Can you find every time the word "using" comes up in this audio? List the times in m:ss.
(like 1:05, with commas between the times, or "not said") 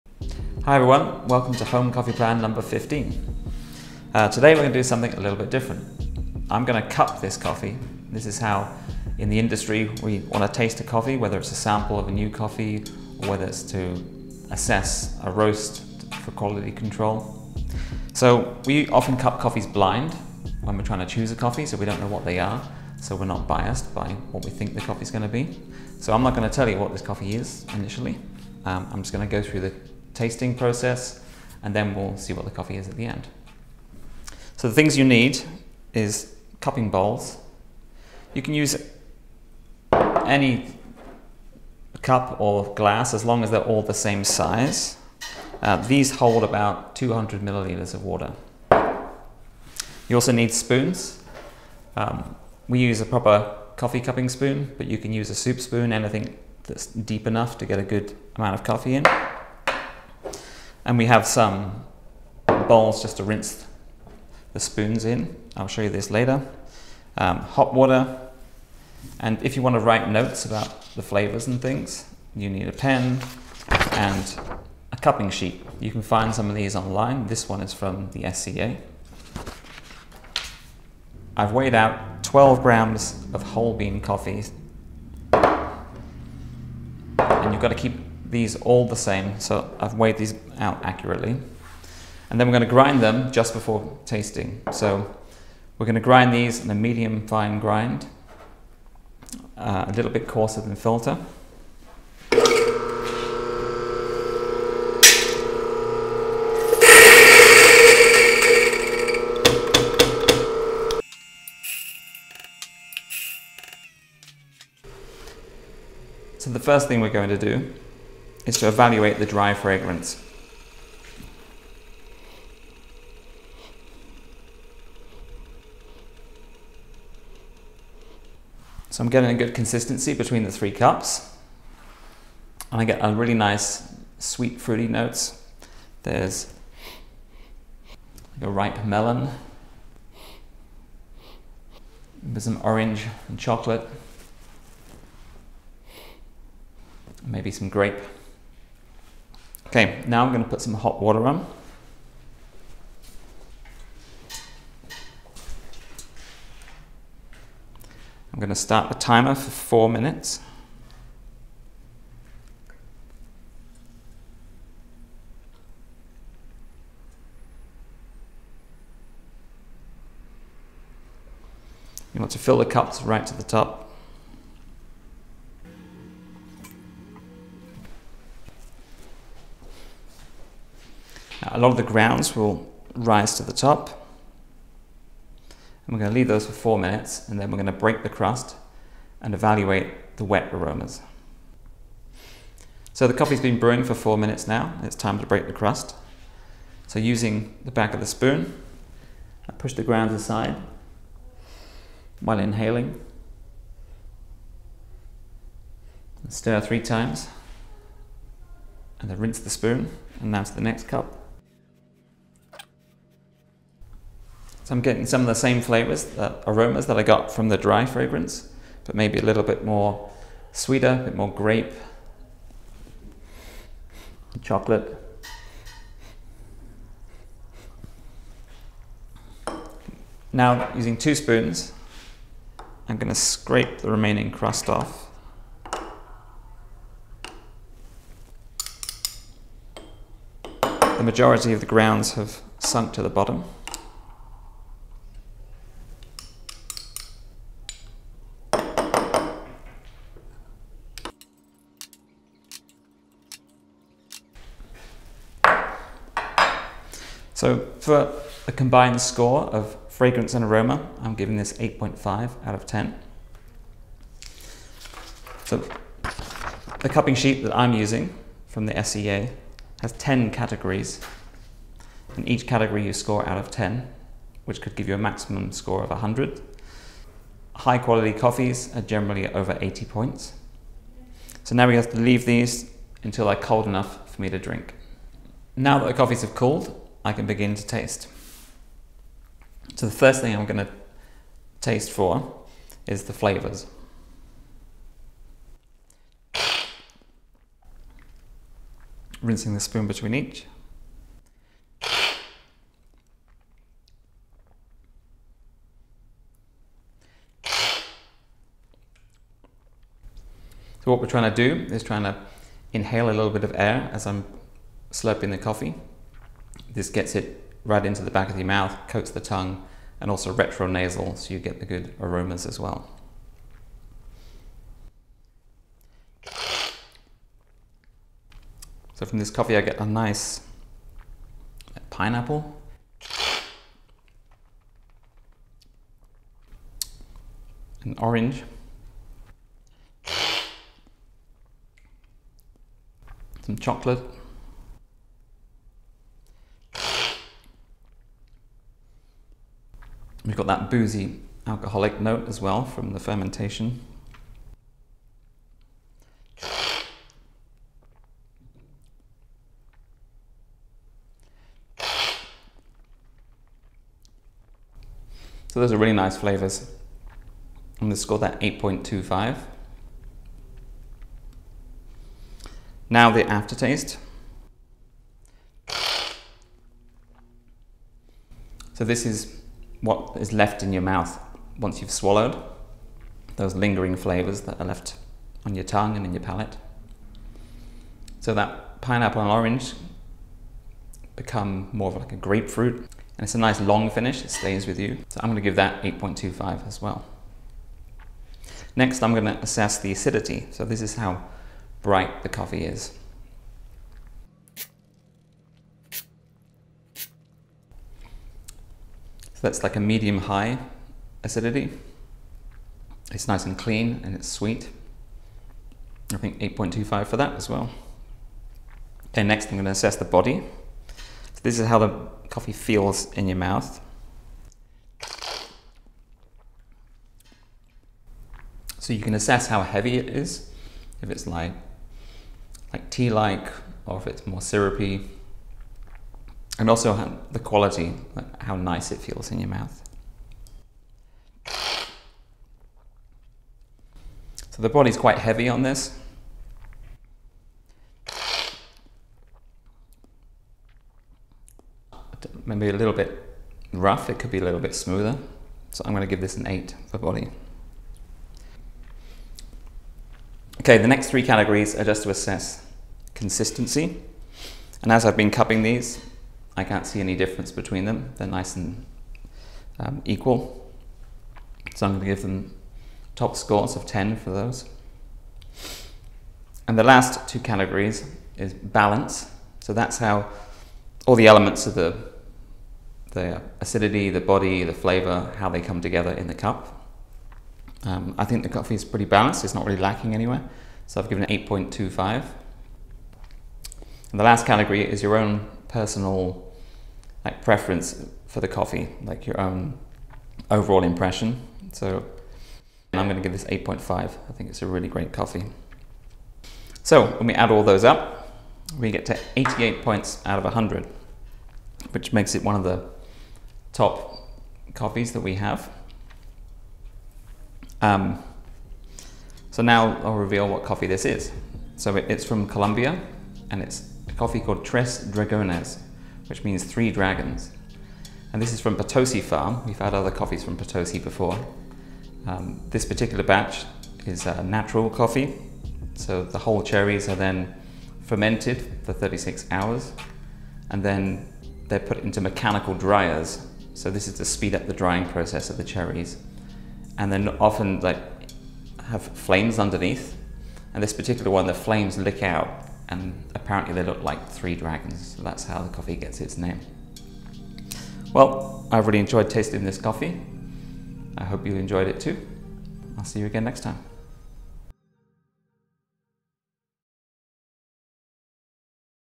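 3:16, 3:50, 4:27.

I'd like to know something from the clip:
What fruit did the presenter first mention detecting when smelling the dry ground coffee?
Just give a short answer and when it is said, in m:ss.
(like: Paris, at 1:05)
Ripe melon, at 2:18.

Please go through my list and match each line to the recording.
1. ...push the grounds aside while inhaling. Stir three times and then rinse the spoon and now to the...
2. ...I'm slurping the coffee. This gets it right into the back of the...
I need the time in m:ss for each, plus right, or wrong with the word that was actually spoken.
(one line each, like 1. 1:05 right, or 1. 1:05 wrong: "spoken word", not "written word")
1. 3:19 right
2. 5:14 right.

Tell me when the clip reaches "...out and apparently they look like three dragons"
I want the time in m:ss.
9:12.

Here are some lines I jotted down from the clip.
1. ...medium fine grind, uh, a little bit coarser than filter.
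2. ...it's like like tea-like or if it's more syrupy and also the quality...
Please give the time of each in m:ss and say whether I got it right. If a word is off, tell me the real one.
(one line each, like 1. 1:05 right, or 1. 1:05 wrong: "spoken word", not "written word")
1. 1:36 right
2. 7:11 right.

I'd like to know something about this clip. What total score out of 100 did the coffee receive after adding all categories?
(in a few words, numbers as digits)
88.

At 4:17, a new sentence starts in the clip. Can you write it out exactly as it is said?
So for a combined score of fragrance and aroma, I'm giving this 8.5 out of 10.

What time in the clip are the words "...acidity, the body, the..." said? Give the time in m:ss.
8:03.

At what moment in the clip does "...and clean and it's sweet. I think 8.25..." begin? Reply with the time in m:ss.
6:53.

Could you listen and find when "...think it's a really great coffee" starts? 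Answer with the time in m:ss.
8:24.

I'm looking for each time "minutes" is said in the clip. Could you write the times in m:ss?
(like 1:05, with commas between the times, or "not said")
2:39, 3:06, 3:14.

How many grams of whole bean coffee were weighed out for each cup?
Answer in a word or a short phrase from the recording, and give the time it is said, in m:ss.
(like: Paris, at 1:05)
12, at 1:22.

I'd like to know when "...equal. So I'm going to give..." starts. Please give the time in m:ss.
7:50.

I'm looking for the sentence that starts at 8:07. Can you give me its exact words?
Um, I think the coffee is pretty balanced.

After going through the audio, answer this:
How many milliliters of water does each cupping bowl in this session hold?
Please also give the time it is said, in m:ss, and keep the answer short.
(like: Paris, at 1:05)
200, at 0:46.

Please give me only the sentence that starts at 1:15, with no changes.
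You can find some of these online.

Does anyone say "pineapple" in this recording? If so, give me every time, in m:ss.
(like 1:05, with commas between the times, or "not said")
5:31, 6:28.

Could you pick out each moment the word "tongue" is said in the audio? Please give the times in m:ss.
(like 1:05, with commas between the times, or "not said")
5:19, 6:25.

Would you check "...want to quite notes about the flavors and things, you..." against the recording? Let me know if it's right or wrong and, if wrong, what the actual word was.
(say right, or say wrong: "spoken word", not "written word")
wrong: "write", not "quite".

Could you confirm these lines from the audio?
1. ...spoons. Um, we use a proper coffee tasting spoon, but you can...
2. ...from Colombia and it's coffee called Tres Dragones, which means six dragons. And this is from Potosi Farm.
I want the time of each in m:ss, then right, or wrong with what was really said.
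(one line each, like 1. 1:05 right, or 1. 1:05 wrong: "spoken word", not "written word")
1. 0:50 wrong: "cupping", not "tasting"
2. 8:42 wrong: "three", not "six".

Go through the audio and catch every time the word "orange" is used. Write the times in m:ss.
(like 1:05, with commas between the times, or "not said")
2:22, 5:37, 6:29.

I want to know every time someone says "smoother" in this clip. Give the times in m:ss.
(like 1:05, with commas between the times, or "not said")
7:34.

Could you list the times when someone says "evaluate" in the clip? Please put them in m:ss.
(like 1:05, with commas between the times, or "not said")
1:58, 3:09.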